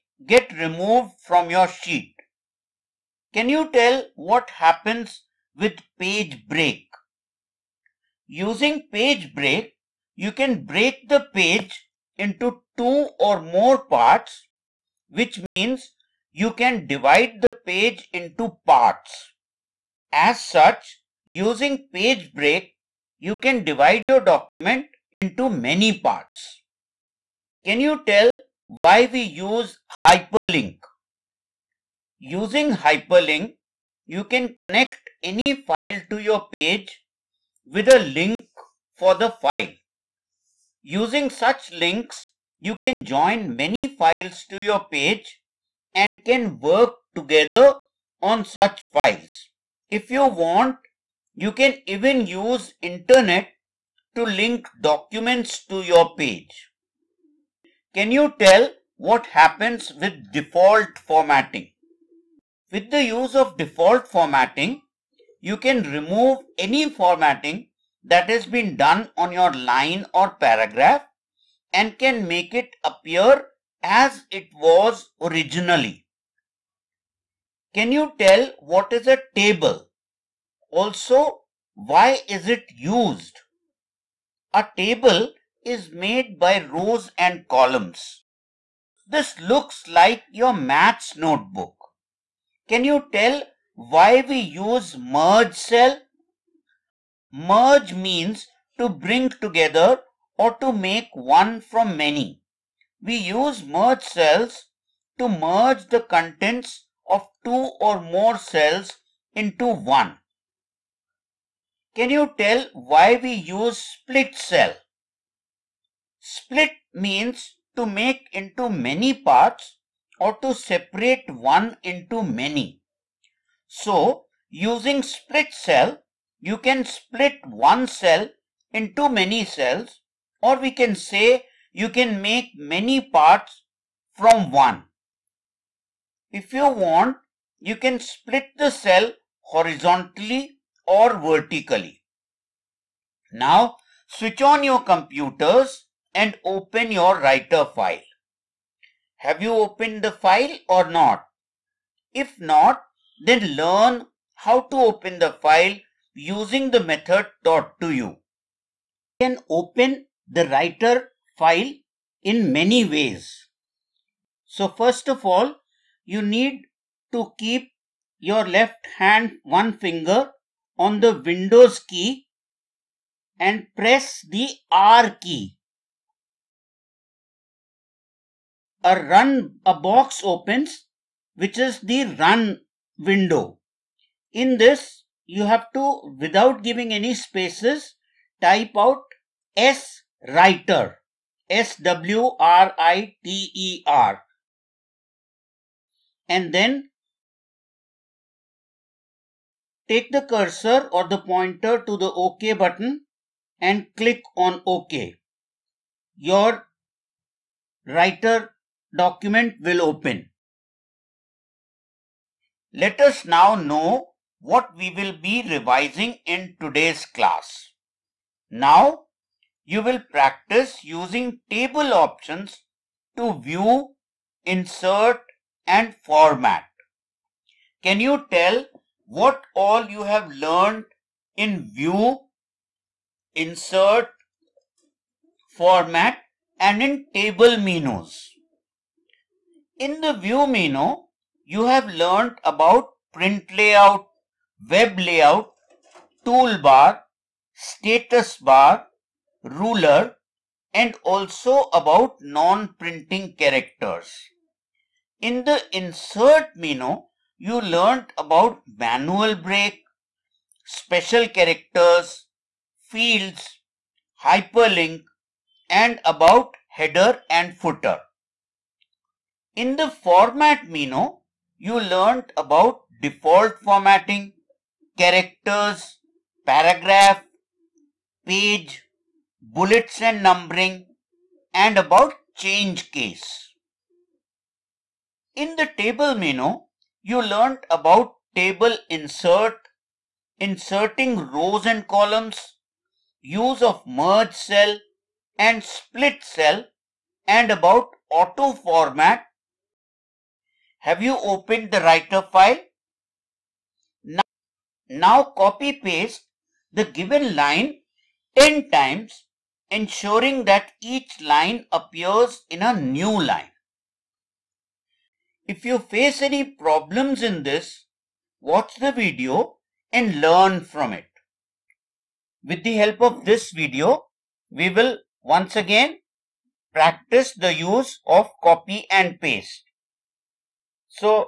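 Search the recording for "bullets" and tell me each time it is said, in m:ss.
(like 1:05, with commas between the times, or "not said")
4:39.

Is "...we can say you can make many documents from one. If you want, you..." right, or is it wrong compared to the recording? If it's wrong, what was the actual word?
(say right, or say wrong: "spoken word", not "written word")
wrong: "parts", not "documents".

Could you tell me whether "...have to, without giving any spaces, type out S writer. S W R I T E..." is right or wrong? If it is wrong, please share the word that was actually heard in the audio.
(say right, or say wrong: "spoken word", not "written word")
right.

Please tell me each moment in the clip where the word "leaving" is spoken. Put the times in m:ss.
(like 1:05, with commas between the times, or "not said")
not said.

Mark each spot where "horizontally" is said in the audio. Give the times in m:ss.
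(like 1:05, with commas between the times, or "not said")
2:19.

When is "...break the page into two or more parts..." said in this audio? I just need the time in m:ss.
0:10.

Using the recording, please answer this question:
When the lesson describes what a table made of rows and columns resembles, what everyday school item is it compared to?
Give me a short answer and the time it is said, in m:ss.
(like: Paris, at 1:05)
maths notebook, at 1:30.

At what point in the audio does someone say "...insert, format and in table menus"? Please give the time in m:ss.
3:53.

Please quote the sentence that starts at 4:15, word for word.
In the insert menu, you learned about manual break, special characters, fields, hyperlink and about header and footer.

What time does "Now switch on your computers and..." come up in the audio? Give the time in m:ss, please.
2:23.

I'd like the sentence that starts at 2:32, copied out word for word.
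If not, then learn how to open the file using the method taught to you.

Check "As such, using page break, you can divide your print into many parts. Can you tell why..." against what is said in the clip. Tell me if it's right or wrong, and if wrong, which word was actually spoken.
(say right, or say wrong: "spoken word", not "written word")
wrong: "document", not "print".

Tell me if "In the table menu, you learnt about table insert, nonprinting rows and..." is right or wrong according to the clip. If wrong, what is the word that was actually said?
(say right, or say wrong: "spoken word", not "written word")
wrong: "inserting", not "nonprinting".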